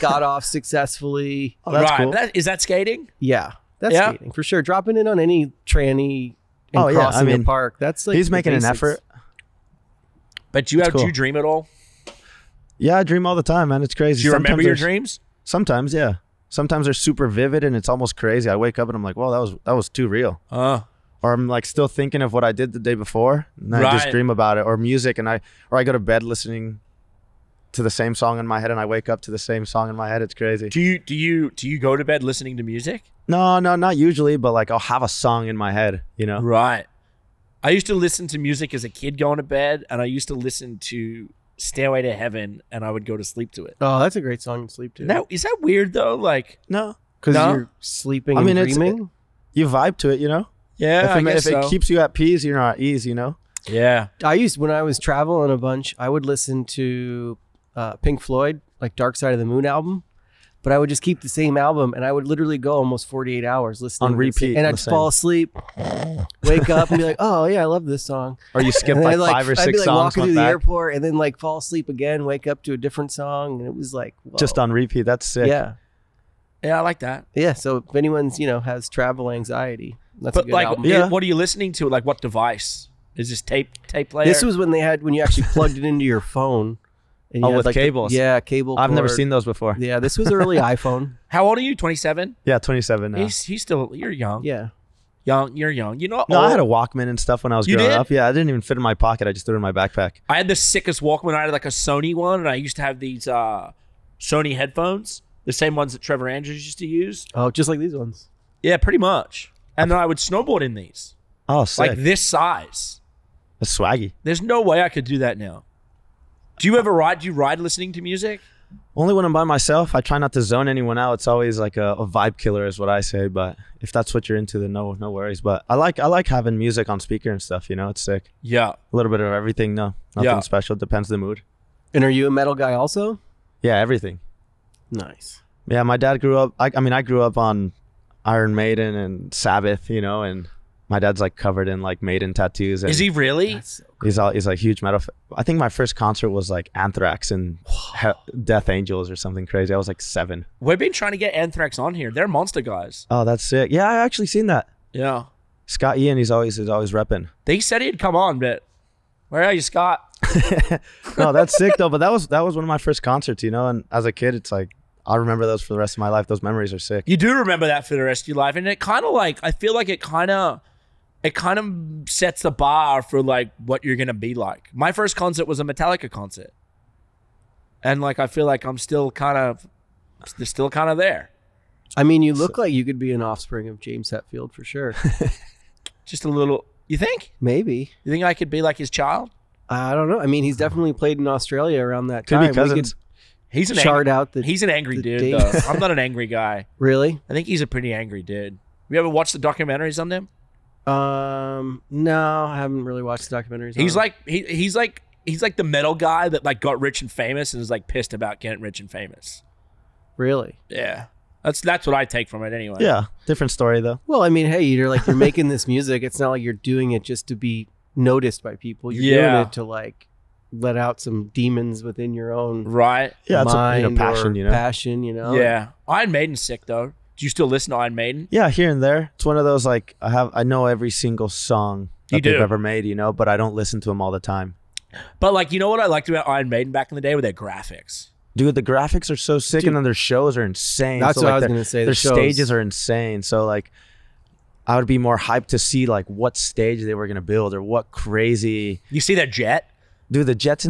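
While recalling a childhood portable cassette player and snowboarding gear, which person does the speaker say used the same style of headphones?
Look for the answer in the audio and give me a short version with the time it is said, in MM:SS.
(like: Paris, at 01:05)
Trevor Andrews, at 01:46.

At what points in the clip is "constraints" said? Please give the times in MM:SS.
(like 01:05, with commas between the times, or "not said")
not said.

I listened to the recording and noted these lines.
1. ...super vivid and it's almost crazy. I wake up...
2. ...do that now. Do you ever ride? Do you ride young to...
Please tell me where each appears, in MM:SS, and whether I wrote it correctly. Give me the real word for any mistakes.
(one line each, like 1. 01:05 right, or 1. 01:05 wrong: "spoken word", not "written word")
1. 00:16 right
2. 01:55 wrong: "listening", not "young".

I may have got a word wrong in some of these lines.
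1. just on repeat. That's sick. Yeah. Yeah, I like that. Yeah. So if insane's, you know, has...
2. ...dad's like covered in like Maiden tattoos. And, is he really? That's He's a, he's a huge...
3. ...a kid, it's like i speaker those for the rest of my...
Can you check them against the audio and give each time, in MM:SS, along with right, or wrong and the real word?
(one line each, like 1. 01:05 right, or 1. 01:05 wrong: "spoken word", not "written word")
1. 01:14 wrong: "anyone", not "insane"
2. 02:20 right
3. 02:44 wrong: "remember", not "speaker".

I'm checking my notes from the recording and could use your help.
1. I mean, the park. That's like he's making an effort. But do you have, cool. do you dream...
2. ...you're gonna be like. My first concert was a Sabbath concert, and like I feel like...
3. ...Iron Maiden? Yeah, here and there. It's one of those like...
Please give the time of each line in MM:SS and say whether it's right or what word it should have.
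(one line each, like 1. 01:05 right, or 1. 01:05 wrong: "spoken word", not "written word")
1. 00:07 right
2. 02:53 wrong: "Metallica", not "Sabbath"
3. 03:47 right.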